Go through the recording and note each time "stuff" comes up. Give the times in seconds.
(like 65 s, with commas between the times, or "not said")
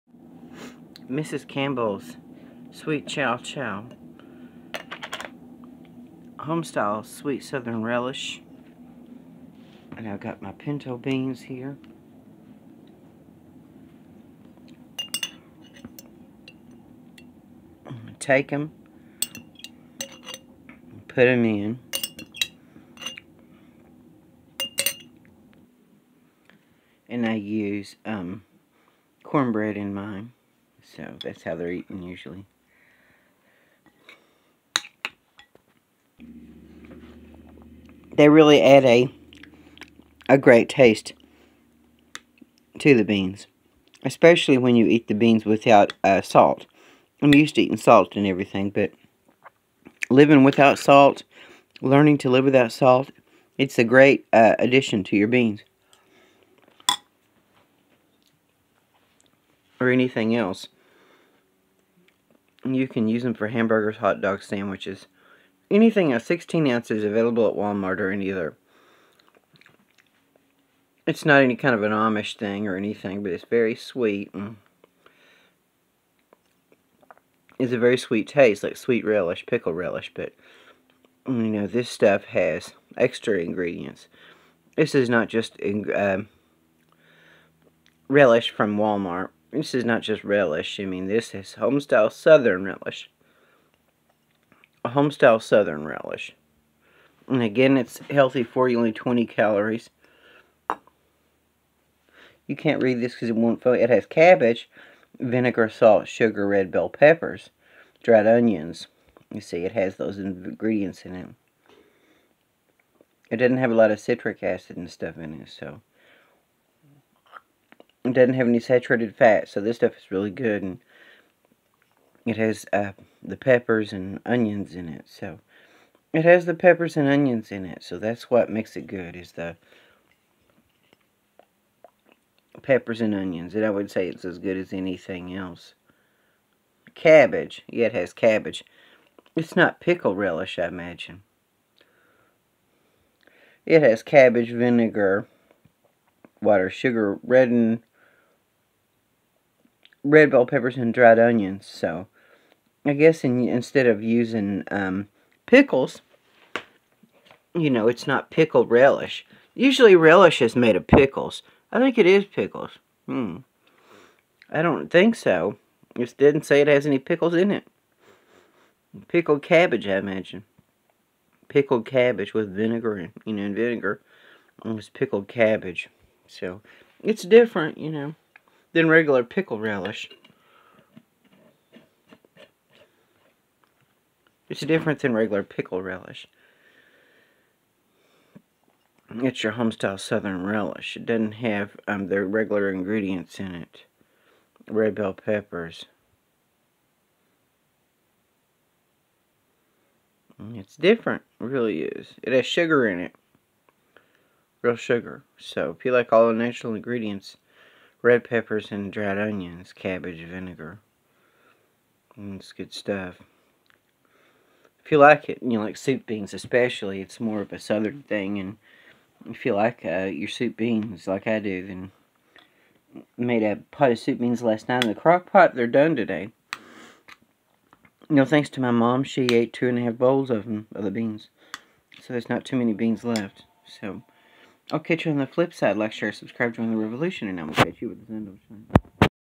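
81 s, 114 s, 119 s, 212 s.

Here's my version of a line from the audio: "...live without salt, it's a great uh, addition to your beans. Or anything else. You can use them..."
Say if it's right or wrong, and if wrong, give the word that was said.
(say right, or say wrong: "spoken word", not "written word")
right.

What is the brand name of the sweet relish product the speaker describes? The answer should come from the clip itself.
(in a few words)
Mrs. Campbell's.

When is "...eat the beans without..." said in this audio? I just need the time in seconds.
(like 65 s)
44 s.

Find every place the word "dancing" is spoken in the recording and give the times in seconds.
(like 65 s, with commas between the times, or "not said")
not said.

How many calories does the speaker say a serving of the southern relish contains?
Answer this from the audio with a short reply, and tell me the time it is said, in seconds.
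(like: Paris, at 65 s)
20, at 98 s.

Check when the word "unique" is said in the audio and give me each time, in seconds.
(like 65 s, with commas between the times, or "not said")
not said.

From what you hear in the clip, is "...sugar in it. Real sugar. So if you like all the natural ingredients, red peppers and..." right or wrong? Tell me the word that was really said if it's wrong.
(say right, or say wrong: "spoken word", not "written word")
right.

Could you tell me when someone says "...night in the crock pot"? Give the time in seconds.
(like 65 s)
224 s.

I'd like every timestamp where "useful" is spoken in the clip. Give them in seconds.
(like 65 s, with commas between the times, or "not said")
not said.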